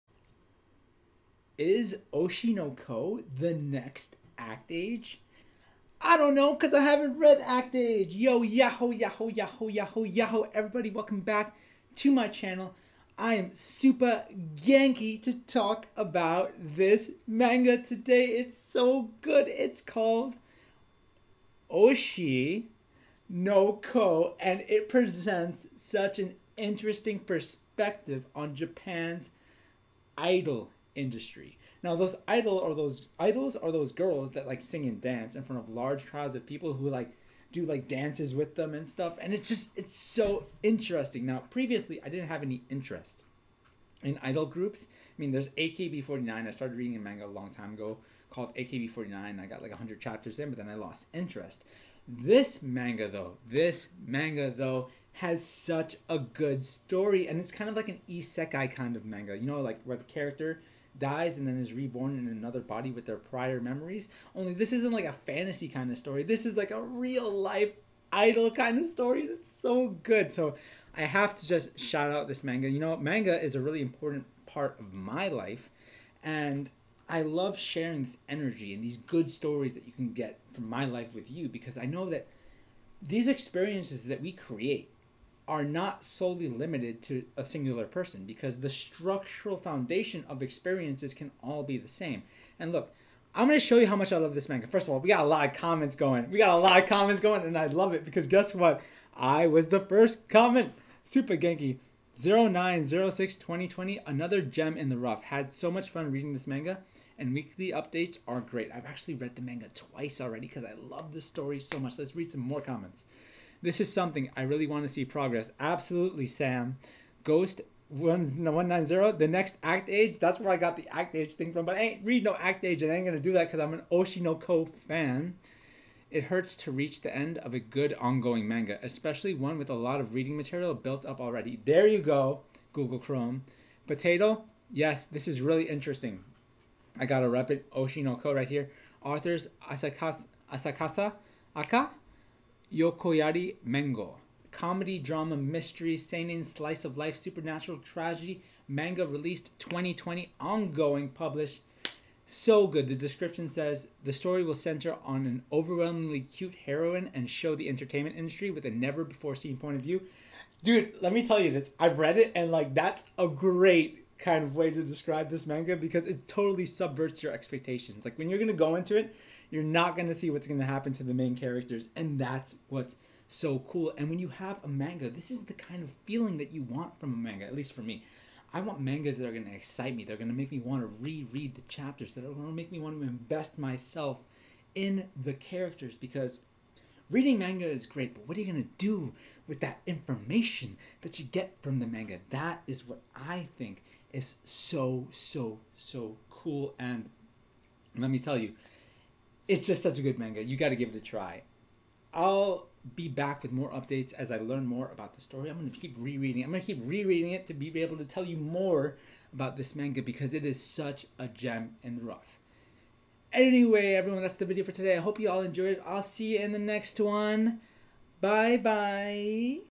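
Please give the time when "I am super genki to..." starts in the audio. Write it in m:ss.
0:13.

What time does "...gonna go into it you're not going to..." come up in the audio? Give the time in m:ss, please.
2:48.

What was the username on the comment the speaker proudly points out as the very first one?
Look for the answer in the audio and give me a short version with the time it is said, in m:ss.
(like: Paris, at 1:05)
Super Genki 0906 2020, at 1:41.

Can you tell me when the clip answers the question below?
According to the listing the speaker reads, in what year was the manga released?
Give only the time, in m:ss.
2:29.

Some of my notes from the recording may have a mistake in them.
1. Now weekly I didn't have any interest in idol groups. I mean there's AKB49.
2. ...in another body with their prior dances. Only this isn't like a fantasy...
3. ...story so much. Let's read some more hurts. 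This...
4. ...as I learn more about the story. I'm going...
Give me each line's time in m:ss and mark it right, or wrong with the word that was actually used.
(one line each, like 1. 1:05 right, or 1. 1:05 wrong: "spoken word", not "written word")
1. 0:41 wrong: "previously", not "weekly"
2. 1:02 wrong: "memories", not "dances"
3. 1:51 wrong: "comments", not "hurts"
4. 3:24 right.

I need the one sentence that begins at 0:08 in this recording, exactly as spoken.
Yo, yahoo, yahoo, yahoo, yahoo, yahoo.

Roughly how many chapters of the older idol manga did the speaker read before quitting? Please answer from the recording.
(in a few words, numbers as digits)
100.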